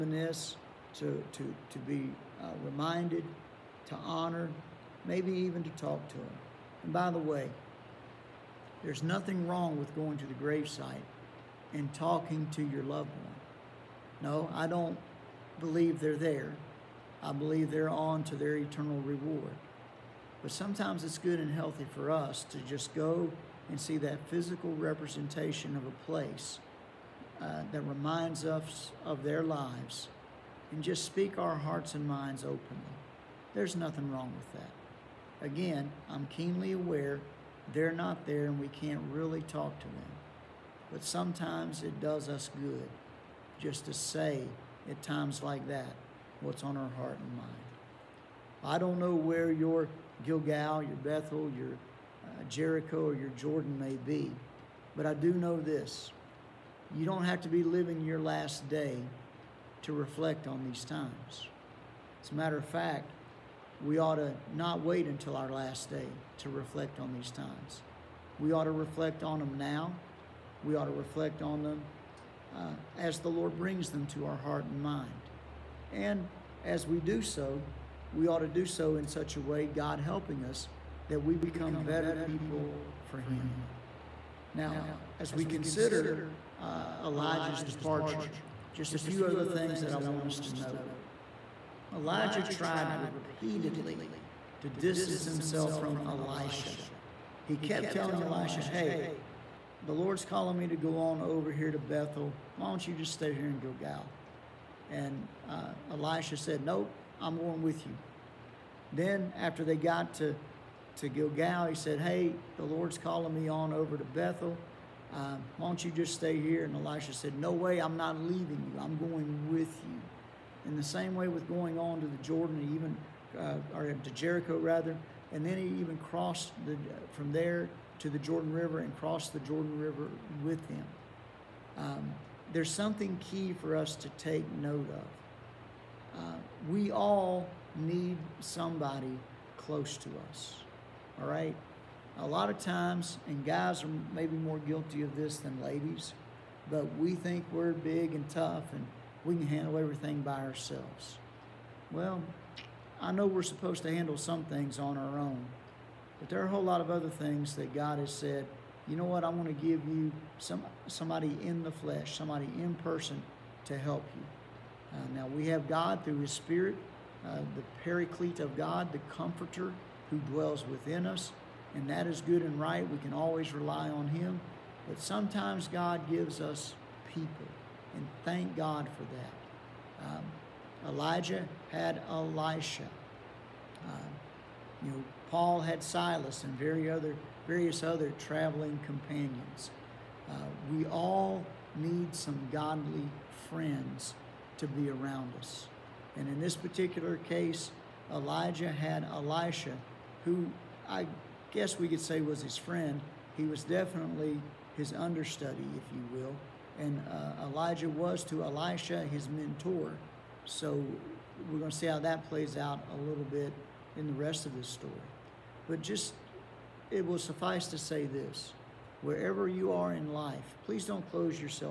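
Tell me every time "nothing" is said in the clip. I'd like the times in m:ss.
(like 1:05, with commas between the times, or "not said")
0:09, 0:33.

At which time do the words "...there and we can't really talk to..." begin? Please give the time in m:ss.
0:38.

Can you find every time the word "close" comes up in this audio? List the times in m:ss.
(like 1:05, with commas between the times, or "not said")
2:19, 3:41.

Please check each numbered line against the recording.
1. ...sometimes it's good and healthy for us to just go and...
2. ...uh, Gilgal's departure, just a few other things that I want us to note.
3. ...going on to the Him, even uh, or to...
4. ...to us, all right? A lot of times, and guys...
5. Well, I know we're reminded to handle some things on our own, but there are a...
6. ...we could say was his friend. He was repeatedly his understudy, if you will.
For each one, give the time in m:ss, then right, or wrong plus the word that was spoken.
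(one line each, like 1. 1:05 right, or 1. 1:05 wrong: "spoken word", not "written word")
1. 0:20 right
2. 1:26 wrong: "Elijah", not "Gilgal"
3. 2:01 wrong: "Jordan", not "Him"
4. 2:19 right
5. 2:31 wrong: "supposed", not "reminded"
6. 3:21 wrong: "definitely", not "repeatedly".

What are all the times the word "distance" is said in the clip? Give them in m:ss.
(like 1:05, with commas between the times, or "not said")
1:34.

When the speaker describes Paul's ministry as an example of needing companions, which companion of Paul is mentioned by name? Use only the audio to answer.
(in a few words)
Silas.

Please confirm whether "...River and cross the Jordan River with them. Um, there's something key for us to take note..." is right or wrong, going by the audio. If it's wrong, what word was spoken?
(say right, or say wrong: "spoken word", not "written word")
right.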